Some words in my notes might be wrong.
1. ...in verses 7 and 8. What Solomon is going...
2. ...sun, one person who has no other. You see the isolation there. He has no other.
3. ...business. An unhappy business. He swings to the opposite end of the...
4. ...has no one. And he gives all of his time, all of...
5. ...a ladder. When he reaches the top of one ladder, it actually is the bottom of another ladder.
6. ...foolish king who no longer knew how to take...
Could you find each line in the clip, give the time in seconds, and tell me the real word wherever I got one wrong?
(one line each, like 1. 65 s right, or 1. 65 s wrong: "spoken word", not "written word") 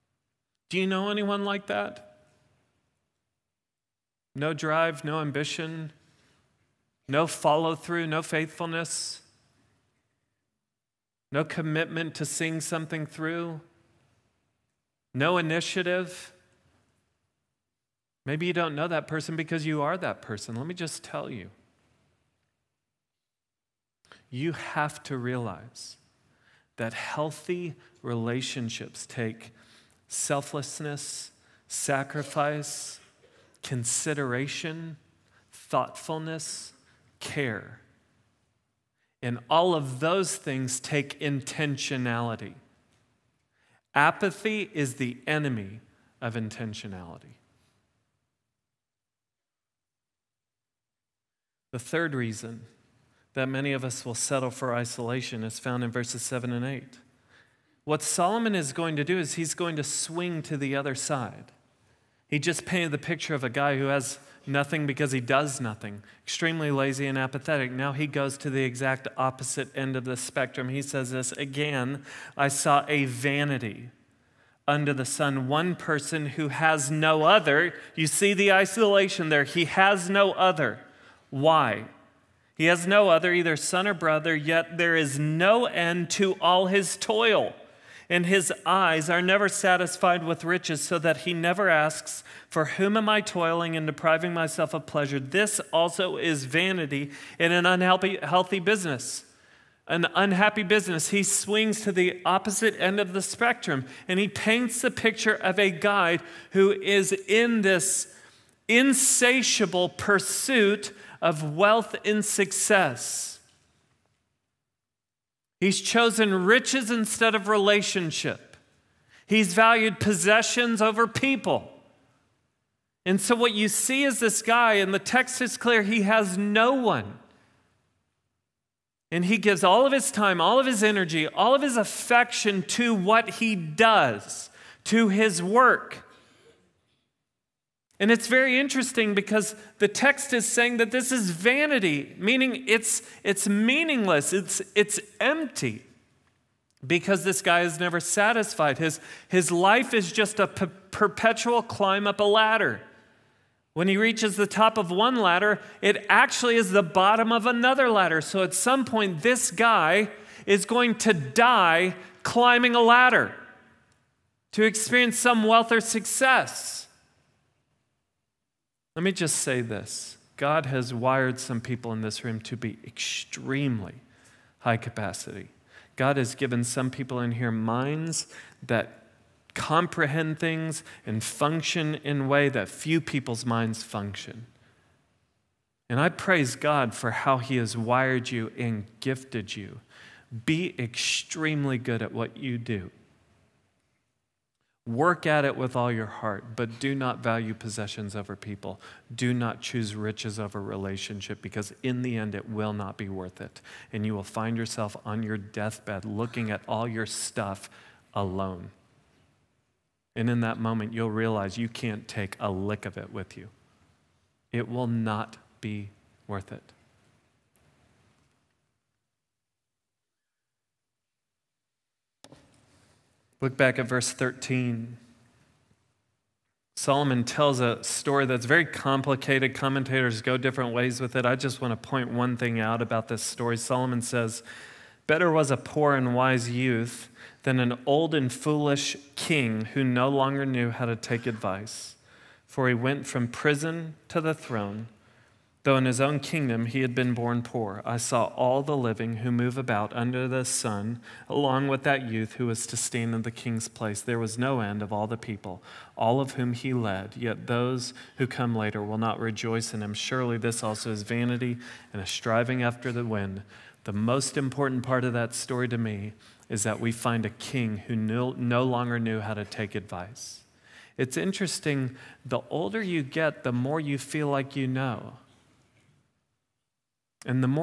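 1. 55 s right
2. 75 s right
3. 98 s right
4. 126 s right
5. 152 s right
6. 238 s right.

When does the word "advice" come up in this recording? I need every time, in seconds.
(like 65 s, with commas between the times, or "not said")
241 s, 269 s.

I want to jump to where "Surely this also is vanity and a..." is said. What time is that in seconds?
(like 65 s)
259 s.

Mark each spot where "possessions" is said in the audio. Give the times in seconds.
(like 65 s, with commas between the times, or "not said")
119 s, 197 s.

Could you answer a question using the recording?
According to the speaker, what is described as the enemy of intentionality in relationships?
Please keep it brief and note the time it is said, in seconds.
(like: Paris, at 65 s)
Apathy, at 43 s.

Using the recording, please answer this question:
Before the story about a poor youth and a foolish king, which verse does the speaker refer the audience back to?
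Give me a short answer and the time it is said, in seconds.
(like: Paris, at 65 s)
13, at 223 s.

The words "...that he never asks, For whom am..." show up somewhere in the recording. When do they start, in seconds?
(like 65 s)
90 s.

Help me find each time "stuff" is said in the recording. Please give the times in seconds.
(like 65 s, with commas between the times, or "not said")
207 s.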